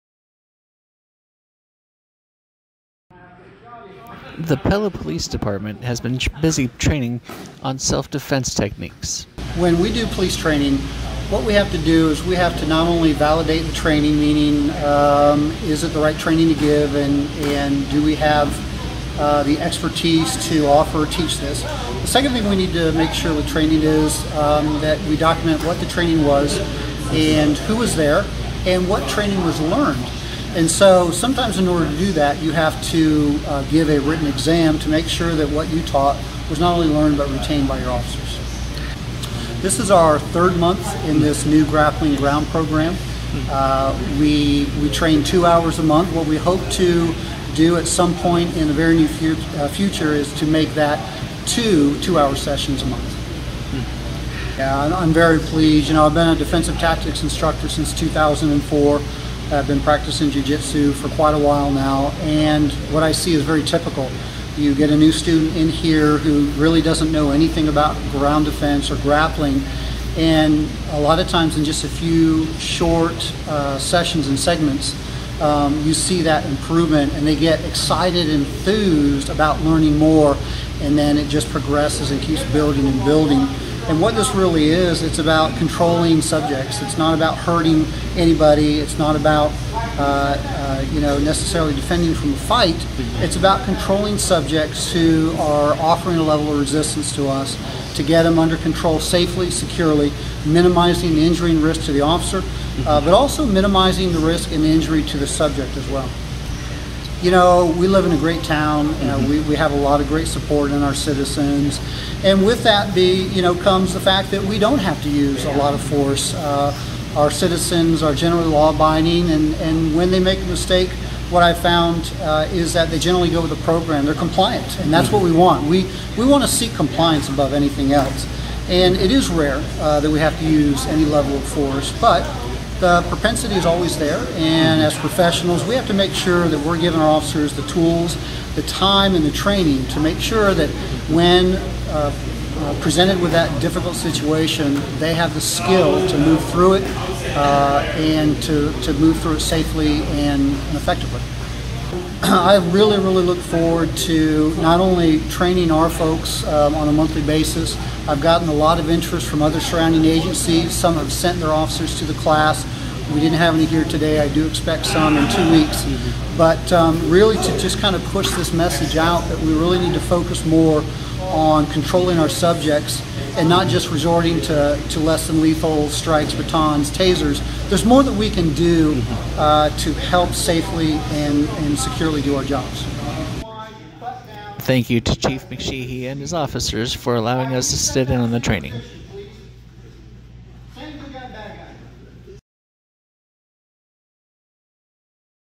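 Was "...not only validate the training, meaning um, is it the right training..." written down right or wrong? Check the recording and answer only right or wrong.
right.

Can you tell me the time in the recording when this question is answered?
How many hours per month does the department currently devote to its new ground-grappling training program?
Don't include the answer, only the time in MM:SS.
00:45.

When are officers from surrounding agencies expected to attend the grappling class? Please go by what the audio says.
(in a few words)
In two weeks.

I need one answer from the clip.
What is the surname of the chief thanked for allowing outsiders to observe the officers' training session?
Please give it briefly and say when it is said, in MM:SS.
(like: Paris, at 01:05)
McSheehy, at 03:05.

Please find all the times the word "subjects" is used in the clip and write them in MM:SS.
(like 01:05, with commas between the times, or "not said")
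01:26, 01:34, 01:45, 02:52.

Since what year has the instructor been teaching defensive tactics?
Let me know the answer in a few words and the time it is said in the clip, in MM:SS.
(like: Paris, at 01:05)
2004, at 00:57.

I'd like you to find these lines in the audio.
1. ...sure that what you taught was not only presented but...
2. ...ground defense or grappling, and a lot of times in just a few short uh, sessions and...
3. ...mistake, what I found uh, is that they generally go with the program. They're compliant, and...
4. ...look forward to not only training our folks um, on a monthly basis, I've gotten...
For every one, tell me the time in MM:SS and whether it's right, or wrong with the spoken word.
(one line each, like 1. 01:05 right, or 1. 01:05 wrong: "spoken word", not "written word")
1. 00:35 wrong: "learned", not "presented"
2. 01:08 right
3. 02:00 right
4. 02:33 right.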